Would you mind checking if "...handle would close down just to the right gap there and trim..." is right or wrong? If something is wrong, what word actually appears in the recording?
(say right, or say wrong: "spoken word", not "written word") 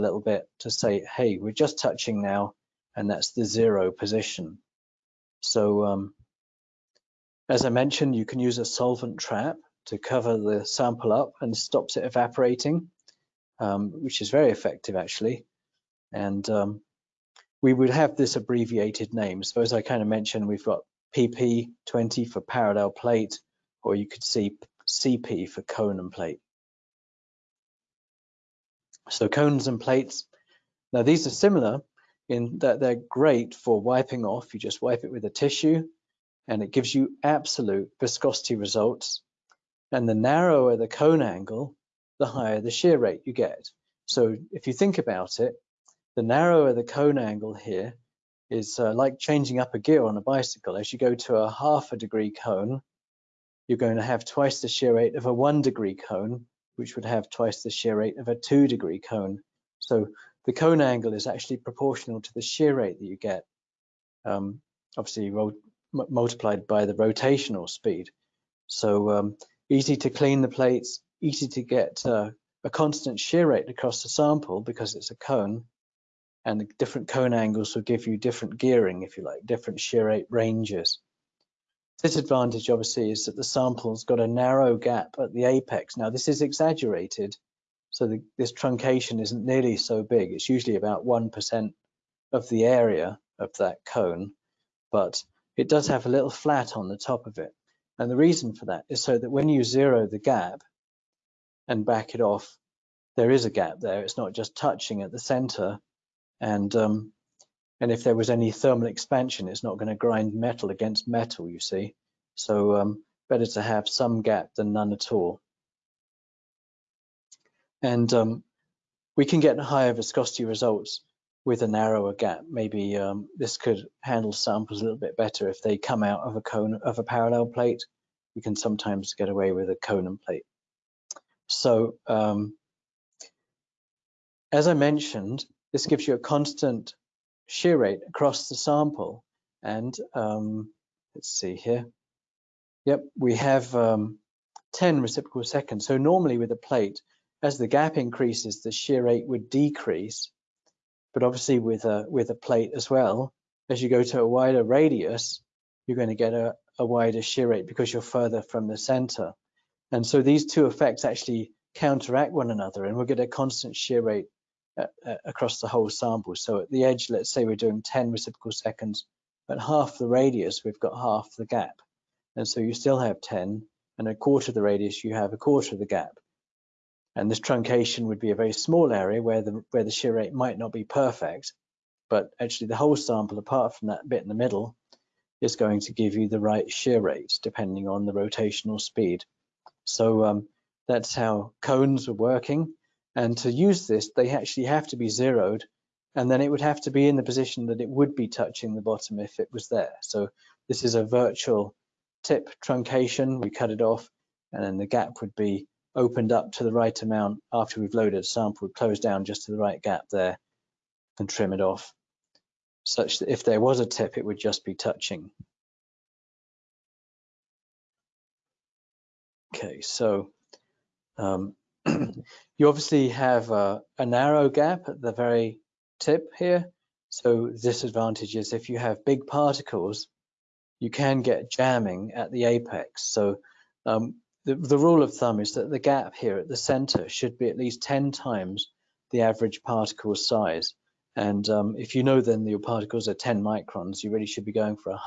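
wrong: "sample", not "handle".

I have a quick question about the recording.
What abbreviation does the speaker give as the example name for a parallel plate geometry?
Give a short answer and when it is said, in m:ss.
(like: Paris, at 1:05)
PP20, at 0:21.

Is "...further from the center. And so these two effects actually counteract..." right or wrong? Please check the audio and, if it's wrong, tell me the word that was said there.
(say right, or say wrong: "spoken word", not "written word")
right.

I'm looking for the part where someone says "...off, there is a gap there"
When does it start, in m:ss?
1:42.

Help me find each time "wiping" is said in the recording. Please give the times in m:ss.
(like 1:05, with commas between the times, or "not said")
0:33.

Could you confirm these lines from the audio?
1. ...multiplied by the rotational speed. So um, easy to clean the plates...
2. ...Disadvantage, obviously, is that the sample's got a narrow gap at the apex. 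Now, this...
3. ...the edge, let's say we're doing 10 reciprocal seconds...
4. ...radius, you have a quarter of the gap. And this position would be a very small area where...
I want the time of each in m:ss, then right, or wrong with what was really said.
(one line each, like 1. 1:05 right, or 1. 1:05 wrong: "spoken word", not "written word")
1. 1:05 right
2. 1:22 right
3. 2:46 right
4. 2:54 wrong: "truncation", not "position".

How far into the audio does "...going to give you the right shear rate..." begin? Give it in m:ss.
3:05.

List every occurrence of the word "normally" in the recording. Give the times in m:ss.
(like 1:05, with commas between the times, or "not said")
2:25.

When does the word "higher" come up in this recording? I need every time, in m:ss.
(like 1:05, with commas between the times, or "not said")
0:42, 1:59.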